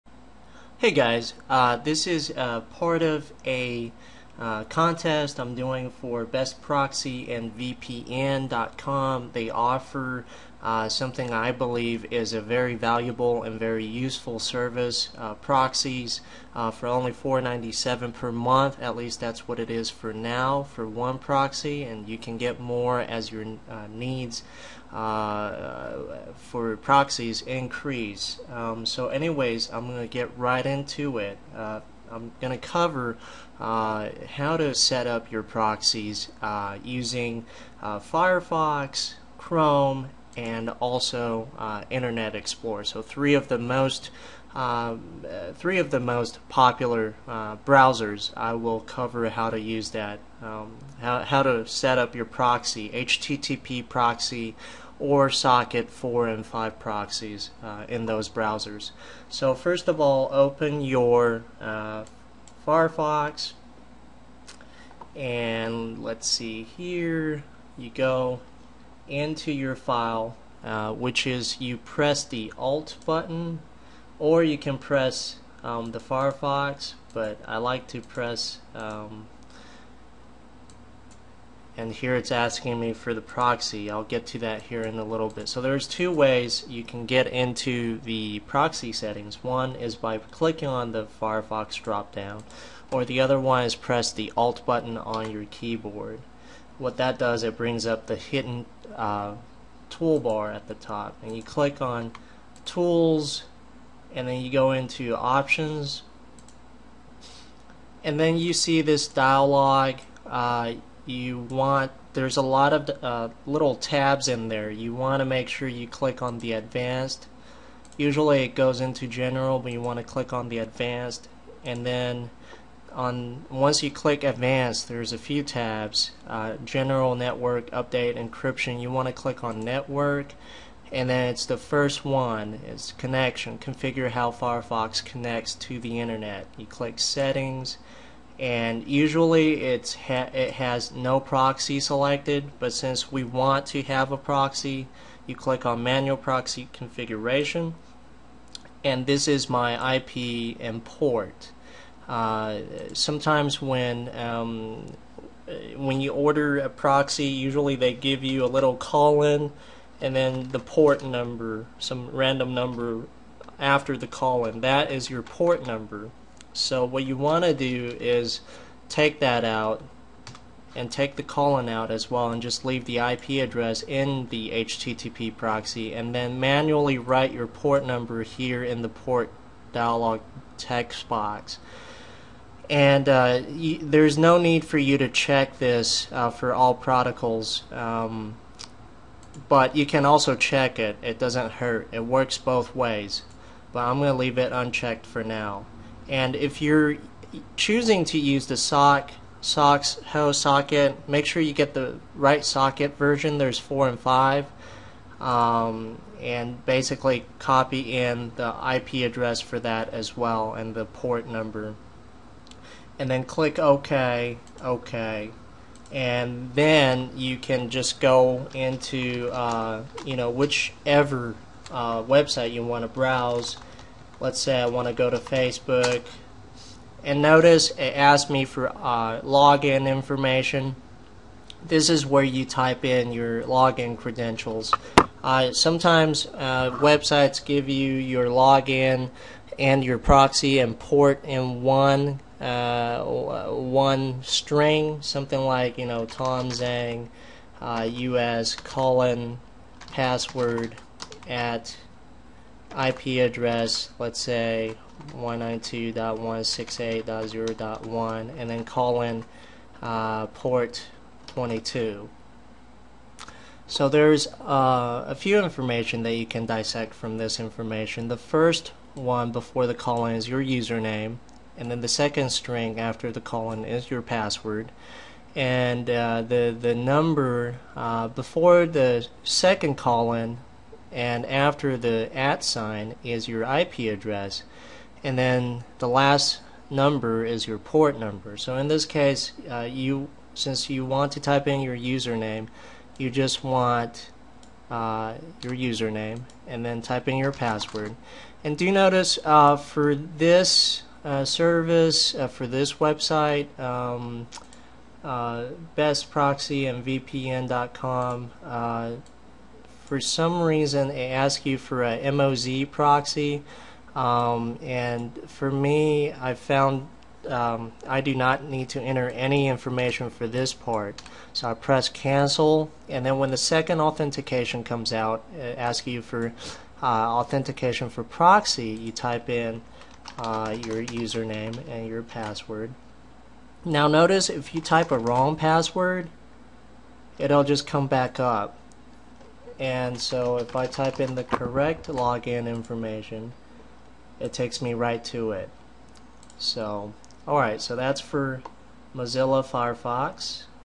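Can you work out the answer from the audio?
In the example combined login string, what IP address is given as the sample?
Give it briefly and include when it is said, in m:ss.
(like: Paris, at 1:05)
192.168.0.1, at 4:15.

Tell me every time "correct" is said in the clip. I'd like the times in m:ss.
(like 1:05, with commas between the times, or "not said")
5:41.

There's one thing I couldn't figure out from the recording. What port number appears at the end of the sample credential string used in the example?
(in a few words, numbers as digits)
22.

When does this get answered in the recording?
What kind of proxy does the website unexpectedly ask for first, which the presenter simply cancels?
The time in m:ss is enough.
5:12.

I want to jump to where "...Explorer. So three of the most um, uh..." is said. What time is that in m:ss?
0:42.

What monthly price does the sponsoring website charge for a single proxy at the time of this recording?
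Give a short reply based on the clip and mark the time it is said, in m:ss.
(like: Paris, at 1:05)
$4.97, at 0:17.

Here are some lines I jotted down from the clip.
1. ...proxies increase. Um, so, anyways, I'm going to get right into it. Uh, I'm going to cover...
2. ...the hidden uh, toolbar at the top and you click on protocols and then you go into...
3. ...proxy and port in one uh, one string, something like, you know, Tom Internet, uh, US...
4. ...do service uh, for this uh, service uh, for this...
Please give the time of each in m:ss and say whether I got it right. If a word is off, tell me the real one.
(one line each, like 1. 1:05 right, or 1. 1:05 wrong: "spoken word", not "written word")
1. 0:26 right
2. 1:38 wrong: "tools", not "protocols"
3. 3:59 wrong: "Zhang", not "Internet"
4. 4:58 wrong: "notice", not "service".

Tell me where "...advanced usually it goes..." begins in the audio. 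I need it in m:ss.
1:56.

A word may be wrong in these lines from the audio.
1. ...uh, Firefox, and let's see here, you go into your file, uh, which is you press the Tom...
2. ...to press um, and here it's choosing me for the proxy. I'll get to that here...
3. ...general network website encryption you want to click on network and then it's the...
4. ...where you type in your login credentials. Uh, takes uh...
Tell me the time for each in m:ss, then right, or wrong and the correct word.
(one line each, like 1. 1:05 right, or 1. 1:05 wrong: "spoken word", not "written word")
1. 1:01 wrong: "Alt", not "Tom"
2. 1:17 wrong: "asking", not "choosing"
3. 2:06 wrong: "update", not "website"
4. 3:52 wrong: "sometimes", not "takes".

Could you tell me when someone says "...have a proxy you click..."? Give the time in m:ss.
2:23.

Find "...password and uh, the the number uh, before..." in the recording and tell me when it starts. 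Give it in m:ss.
4:34.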